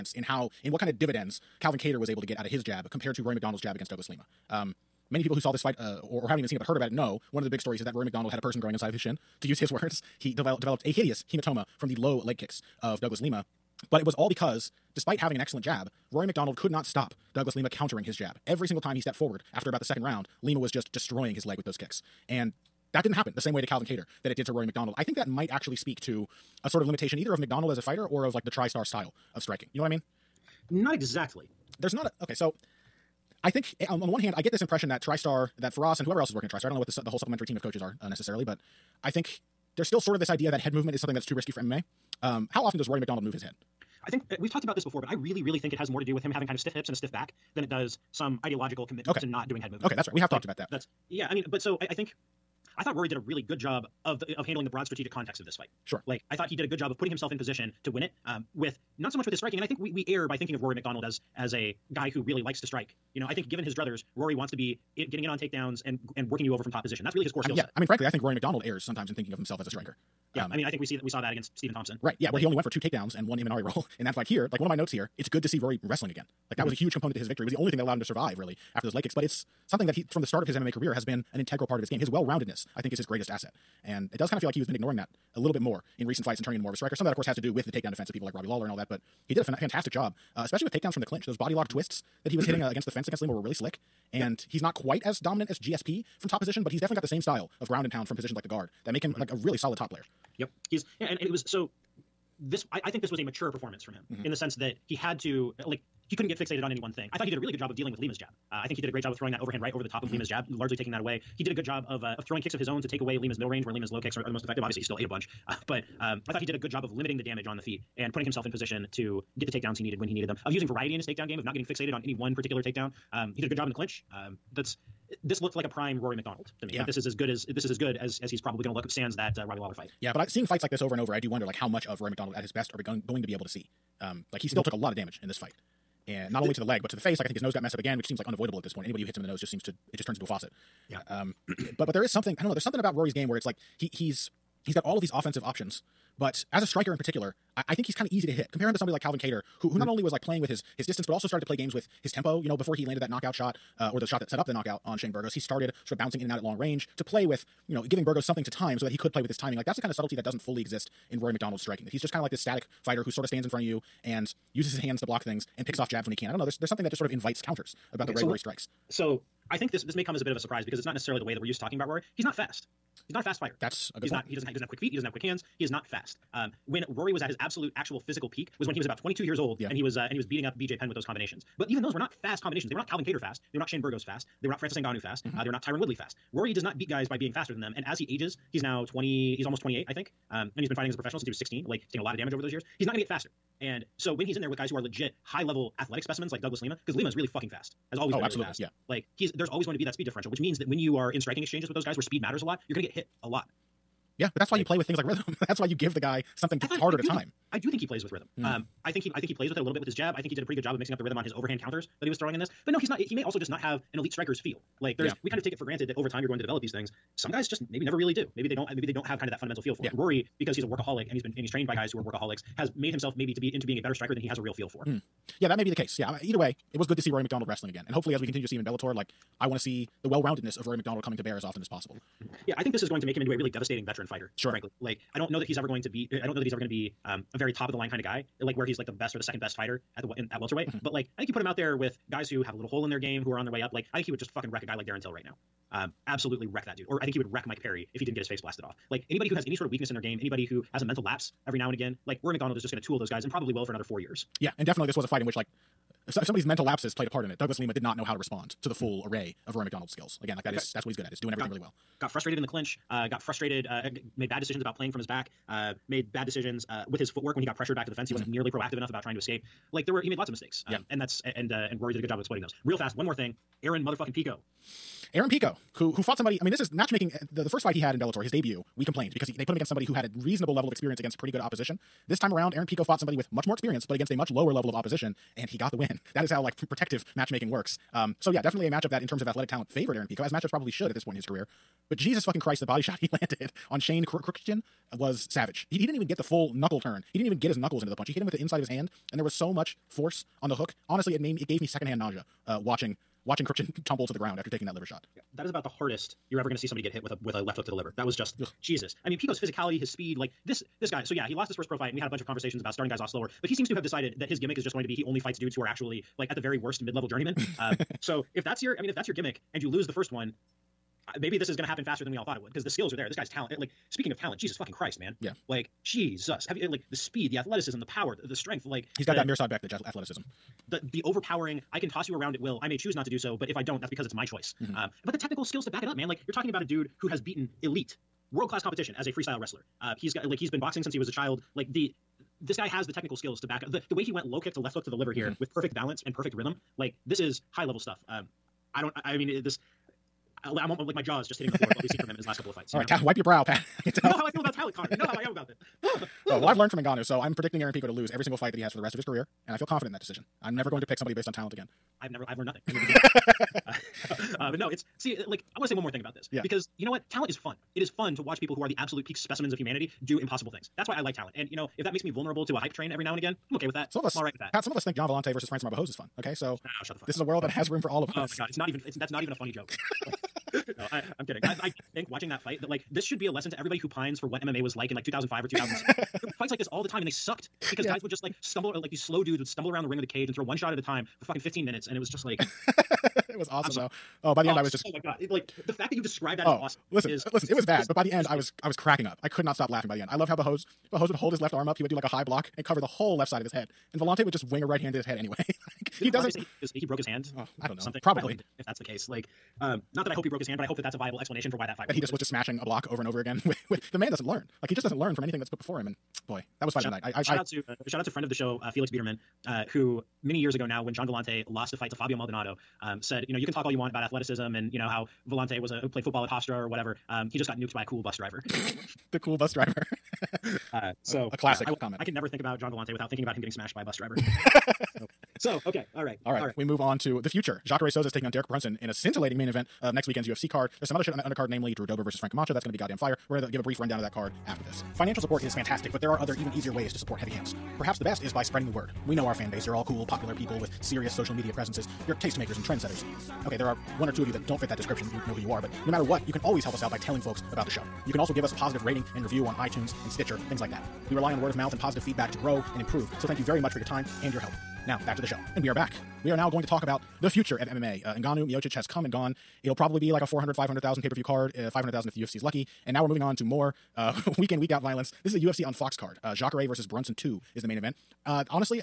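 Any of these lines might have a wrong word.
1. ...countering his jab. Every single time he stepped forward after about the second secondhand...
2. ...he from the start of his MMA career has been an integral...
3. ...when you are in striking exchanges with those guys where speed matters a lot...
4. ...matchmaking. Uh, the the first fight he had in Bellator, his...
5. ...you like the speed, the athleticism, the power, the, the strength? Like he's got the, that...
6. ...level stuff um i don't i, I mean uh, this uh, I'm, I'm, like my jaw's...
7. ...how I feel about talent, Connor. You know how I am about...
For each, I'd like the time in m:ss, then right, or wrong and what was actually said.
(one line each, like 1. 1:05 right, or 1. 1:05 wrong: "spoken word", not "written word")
1. 0:17 wrong: "round", not "secondhand"
2. 1:19 right
3. 3:20 right
4. 4:36 right
5. 5:26 right
6. 5:47 right
7. 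5:54 right.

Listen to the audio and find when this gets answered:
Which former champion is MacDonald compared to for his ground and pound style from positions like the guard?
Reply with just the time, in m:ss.
1:35.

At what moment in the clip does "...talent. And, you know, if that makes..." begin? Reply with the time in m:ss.
6:11.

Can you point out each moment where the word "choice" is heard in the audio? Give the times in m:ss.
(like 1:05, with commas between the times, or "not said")
5:34.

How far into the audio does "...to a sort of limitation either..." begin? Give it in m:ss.
0:26.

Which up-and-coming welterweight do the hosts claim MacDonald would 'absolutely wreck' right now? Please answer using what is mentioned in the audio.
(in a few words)
Darren Till.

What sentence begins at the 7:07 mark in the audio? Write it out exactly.
Um, he just got nuked by a cool bus driver.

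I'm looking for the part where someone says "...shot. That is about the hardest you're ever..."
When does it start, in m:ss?
5:04.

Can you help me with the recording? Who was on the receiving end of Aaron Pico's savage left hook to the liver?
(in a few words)
Shane Kruchten.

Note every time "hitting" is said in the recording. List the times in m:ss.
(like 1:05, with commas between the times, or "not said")
1:32, 5:51.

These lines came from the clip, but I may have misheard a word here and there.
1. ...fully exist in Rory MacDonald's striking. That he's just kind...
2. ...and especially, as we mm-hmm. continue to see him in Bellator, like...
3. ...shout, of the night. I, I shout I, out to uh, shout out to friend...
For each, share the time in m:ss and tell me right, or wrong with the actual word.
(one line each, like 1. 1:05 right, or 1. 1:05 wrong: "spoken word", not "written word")
1. 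2:40 right
2. 3:47 wrong: "hopefully", not "especially"
3. 6:56 right.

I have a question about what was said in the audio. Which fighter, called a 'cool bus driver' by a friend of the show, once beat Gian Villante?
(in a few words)
Fabio Maldonado.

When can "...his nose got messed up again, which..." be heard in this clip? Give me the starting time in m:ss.
2:17.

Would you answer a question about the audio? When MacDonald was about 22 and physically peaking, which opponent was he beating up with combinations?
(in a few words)
BJ Penn.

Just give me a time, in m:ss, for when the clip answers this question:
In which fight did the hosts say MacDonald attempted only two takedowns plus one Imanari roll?
1:11.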